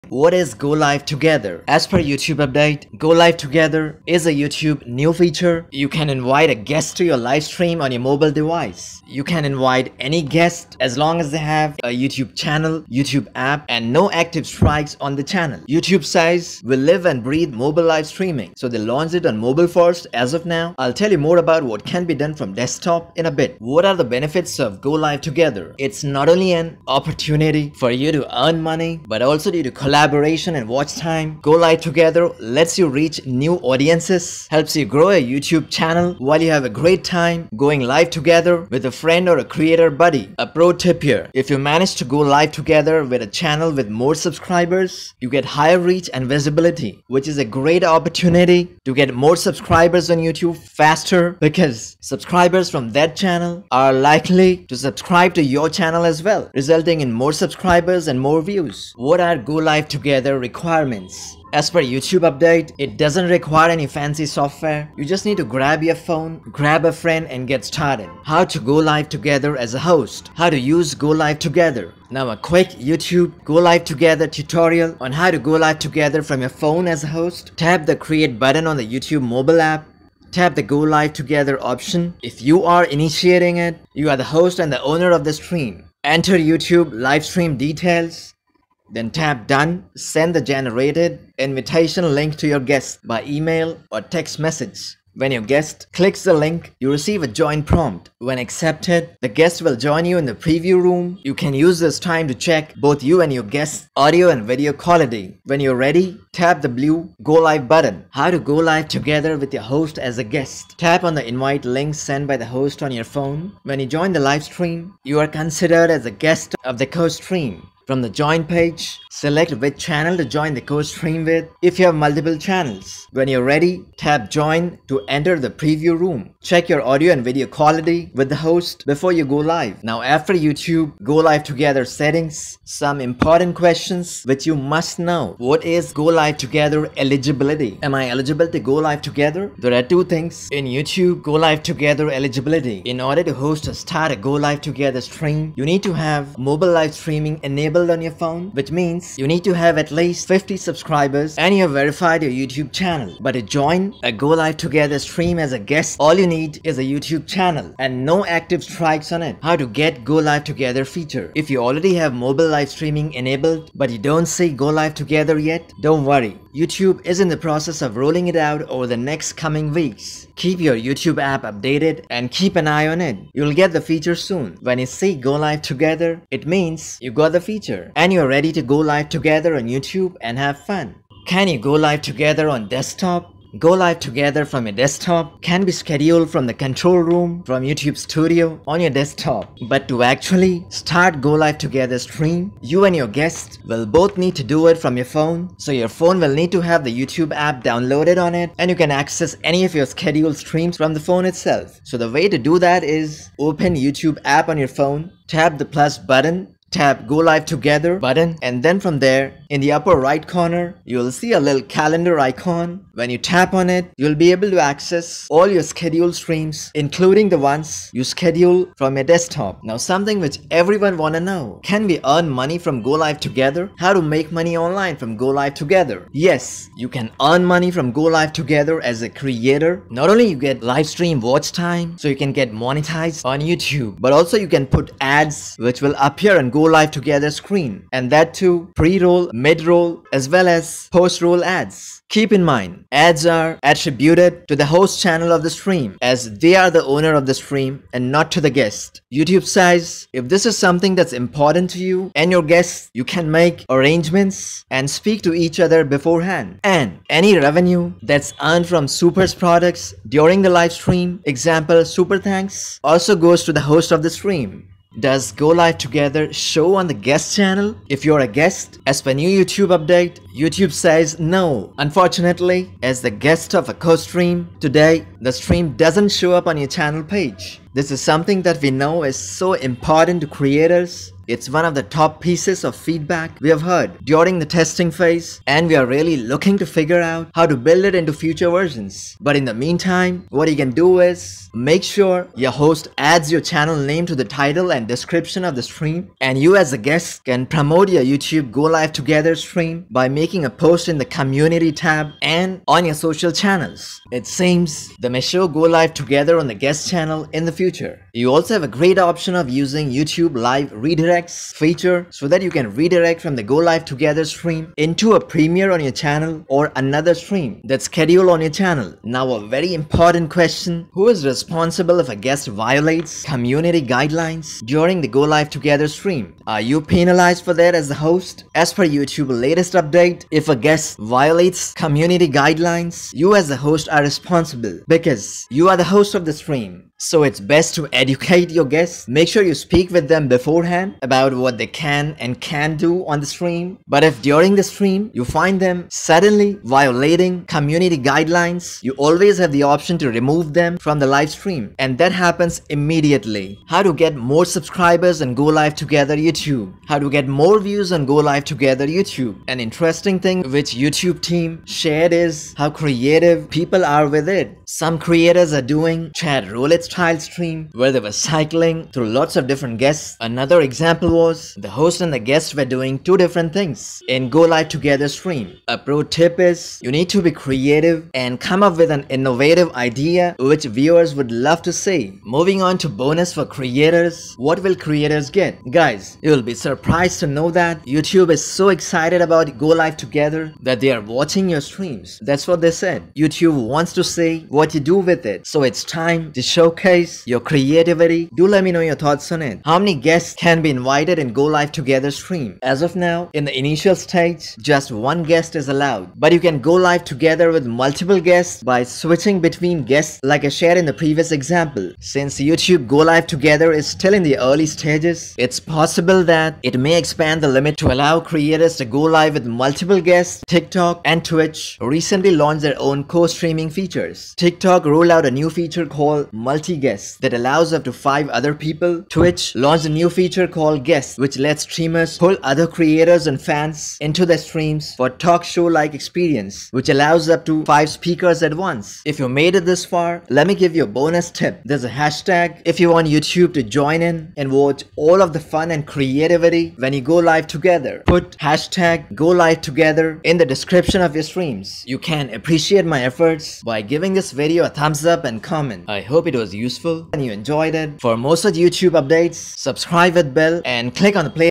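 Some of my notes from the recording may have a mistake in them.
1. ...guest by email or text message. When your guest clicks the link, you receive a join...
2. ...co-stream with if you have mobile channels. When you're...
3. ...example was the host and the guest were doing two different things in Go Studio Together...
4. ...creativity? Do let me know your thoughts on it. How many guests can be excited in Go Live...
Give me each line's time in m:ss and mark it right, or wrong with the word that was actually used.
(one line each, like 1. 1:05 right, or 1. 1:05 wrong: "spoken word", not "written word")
1. 1:32 right
2. 2:00 wrong: "multiple", not "mobile"
3. 6:10 wrong: "Live", not "Studio"
4. 6:37 wrong: "invited", not "excited".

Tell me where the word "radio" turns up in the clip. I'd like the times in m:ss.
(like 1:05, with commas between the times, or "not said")
not said.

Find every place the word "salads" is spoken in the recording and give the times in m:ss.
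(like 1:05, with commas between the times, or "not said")
not said.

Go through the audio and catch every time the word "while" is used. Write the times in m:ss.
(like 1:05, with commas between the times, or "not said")
0:36.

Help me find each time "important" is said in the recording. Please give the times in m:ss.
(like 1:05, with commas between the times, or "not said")
2:13, 4:11, 4:39, 5:19.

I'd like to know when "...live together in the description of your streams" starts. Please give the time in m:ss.
7:29.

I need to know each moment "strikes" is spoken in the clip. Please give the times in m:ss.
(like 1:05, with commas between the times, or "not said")
0:14, 2:38.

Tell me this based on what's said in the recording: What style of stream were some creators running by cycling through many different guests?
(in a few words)
chat roulette.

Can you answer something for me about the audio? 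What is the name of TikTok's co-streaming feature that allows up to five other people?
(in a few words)
Multi guests.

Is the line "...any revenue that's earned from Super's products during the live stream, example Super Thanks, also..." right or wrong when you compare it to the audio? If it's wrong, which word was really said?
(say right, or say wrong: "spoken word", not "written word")
right.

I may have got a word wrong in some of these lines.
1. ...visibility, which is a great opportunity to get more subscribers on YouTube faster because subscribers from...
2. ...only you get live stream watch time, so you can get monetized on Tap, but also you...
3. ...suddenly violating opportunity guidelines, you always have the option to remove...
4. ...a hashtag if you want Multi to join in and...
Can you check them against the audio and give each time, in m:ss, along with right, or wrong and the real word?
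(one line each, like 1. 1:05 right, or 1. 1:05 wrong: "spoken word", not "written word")
1. 0:46 right
2. 3:50 wrong: "YouTube", not "Tap"
3. 5:45 wrong: "community", not "opportunity"
4. 7:21 wrong: "YouTube", not "Multi".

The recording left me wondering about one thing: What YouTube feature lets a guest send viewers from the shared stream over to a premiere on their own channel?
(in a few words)
Live Redirects.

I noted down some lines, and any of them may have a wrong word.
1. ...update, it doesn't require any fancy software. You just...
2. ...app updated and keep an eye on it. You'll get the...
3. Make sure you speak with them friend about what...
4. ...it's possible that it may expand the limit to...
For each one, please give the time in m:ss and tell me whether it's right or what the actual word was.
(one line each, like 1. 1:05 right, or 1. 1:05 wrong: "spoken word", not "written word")
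1. 1:02 right
2. 2:51 right
3. 5:39 wrong: "beforehand", not "friend"
4. 6:55 right.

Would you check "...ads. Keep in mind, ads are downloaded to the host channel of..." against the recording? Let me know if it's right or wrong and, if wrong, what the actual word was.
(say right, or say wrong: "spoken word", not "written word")
wrong: "attributed", not "downloaded".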